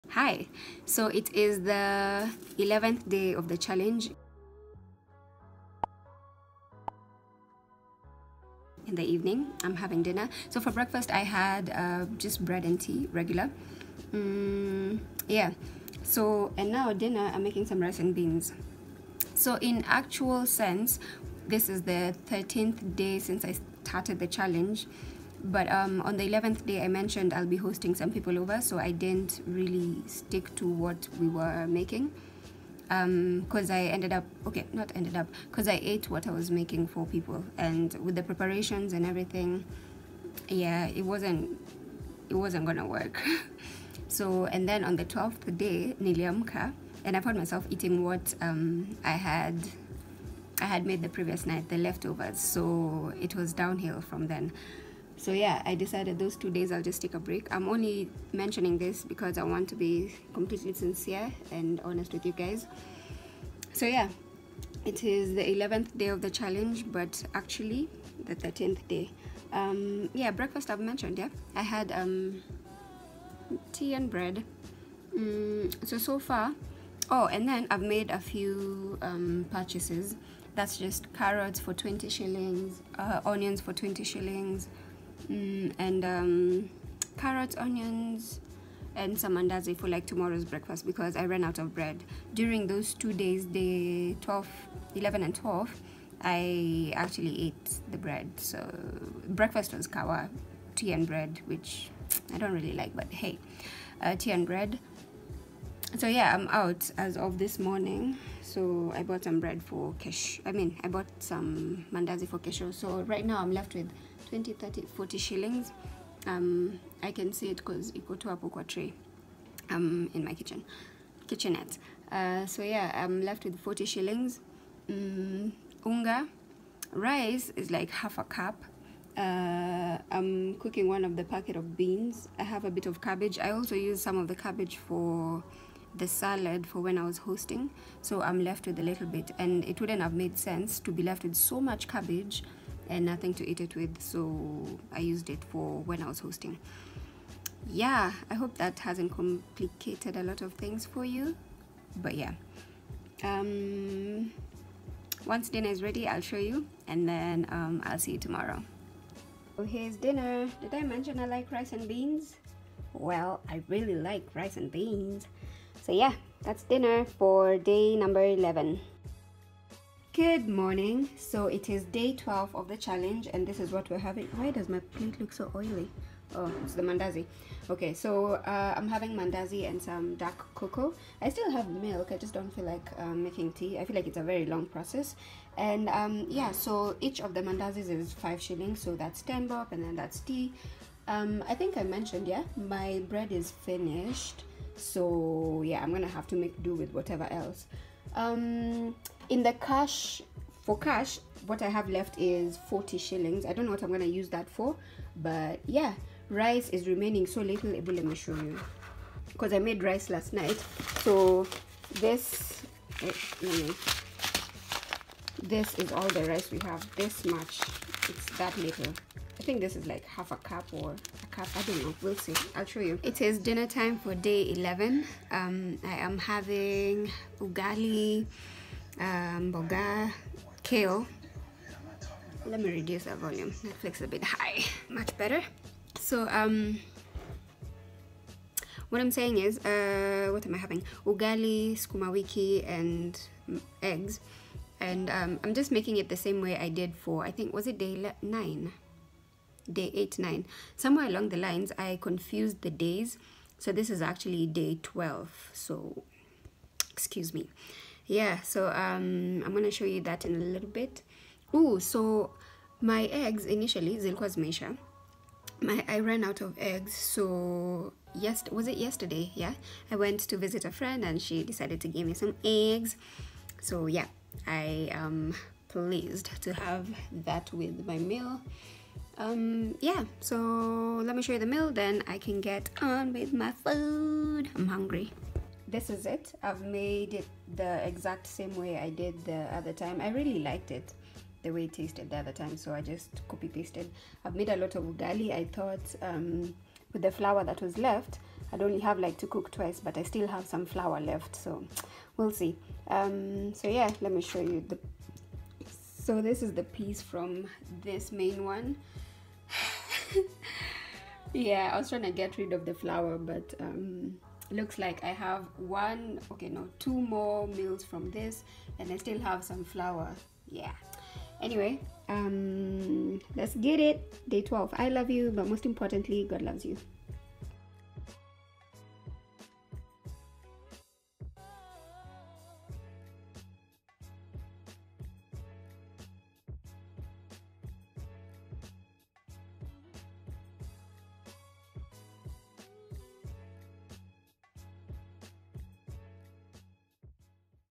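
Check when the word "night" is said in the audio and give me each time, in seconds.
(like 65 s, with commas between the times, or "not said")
51 s, 210 s.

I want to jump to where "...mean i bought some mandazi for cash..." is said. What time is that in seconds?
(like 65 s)
110 s.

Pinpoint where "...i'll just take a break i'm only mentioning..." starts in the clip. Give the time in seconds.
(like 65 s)
56 s.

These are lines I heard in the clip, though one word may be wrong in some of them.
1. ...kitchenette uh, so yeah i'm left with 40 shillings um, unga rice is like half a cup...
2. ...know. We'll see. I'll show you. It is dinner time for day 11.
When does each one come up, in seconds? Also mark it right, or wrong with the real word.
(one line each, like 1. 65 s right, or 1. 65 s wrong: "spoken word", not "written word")
1. 121 s right
2. 221 s right.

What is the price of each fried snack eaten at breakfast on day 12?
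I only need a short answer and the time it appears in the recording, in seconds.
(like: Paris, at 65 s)
5 shillings, at 188 s.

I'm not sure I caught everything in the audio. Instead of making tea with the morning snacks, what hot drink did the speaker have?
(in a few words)
Dark cocoa.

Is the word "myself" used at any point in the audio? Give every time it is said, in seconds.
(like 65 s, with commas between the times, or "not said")
47 s.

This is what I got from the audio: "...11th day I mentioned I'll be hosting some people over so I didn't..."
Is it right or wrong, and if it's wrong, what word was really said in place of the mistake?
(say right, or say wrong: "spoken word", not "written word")
right.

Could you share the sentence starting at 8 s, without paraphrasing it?
In the evening, I'm having dinner.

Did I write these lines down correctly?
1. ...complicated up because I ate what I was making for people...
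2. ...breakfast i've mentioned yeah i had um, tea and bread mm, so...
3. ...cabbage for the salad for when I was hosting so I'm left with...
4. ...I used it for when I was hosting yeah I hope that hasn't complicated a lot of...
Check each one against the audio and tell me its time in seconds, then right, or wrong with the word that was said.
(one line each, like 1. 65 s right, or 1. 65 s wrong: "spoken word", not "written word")
1. 34 s wrong: "ended", not "complicated"
2. 70 s right
3. 134 s right
4. 144 s right.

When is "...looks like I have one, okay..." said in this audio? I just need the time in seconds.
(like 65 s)
314 s.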